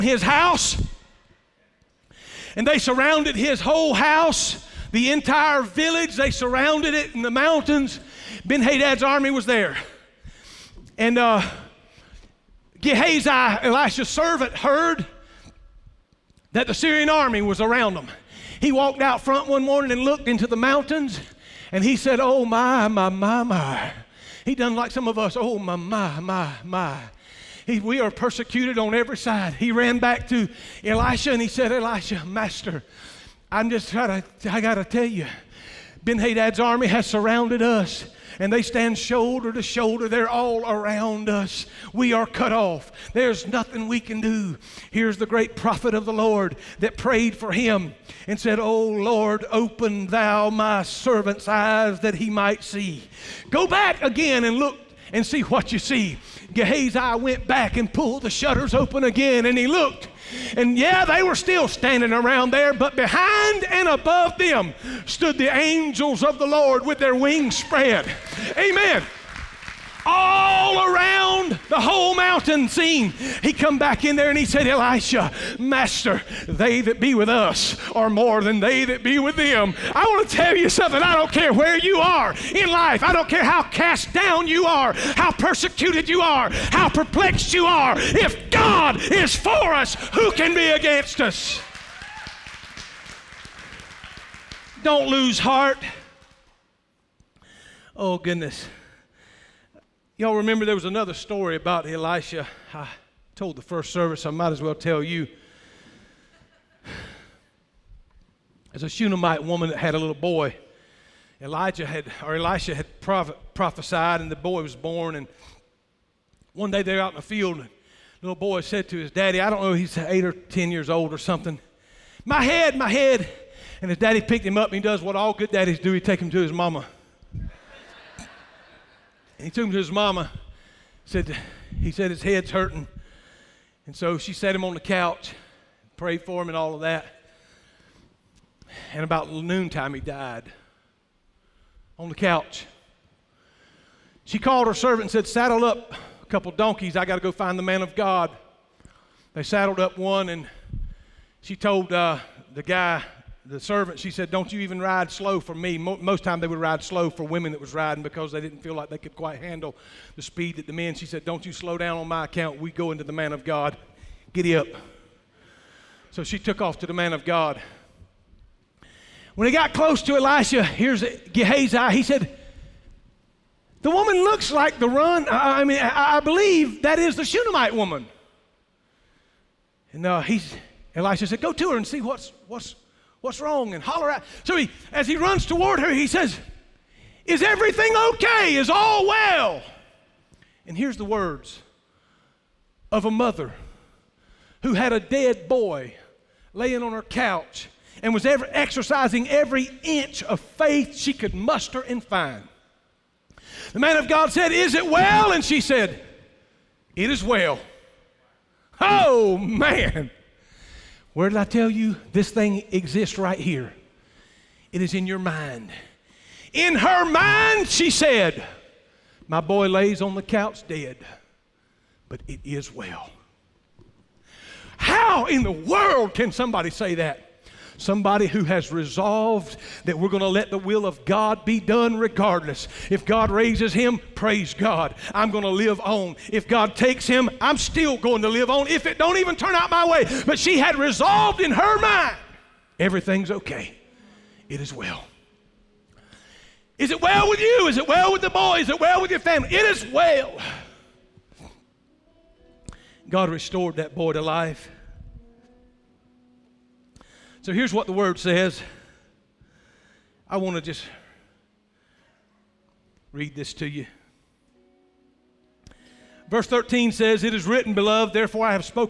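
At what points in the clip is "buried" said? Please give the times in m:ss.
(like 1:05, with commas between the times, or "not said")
not said.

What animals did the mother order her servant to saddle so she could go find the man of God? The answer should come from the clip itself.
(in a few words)
donkeys.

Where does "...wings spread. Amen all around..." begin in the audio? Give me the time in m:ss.
1:07.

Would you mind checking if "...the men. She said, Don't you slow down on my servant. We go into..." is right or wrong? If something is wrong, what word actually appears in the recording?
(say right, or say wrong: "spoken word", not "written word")
wrong: "account", not "servant".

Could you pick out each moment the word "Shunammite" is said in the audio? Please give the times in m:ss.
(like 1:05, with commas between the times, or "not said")
1:48, 2:57.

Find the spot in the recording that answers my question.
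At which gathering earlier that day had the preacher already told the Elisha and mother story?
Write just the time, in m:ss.
1:43.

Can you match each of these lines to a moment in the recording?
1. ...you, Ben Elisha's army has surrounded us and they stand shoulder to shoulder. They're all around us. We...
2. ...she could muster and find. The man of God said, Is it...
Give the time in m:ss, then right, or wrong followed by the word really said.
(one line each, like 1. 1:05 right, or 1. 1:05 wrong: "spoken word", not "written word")
1. 0:35 wrong: "Hadad", not "Elisha"
2. 3:20 right.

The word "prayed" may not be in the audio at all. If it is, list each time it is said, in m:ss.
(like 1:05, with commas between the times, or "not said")
0:46, 2:15.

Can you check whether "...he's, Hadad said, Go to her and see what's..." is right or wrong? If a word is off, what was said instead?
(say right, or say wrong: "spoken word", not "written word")
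wrong: "Elisha", not "Hadad".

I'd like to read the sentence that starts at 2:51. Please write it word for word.
He said, The woman looks like the run.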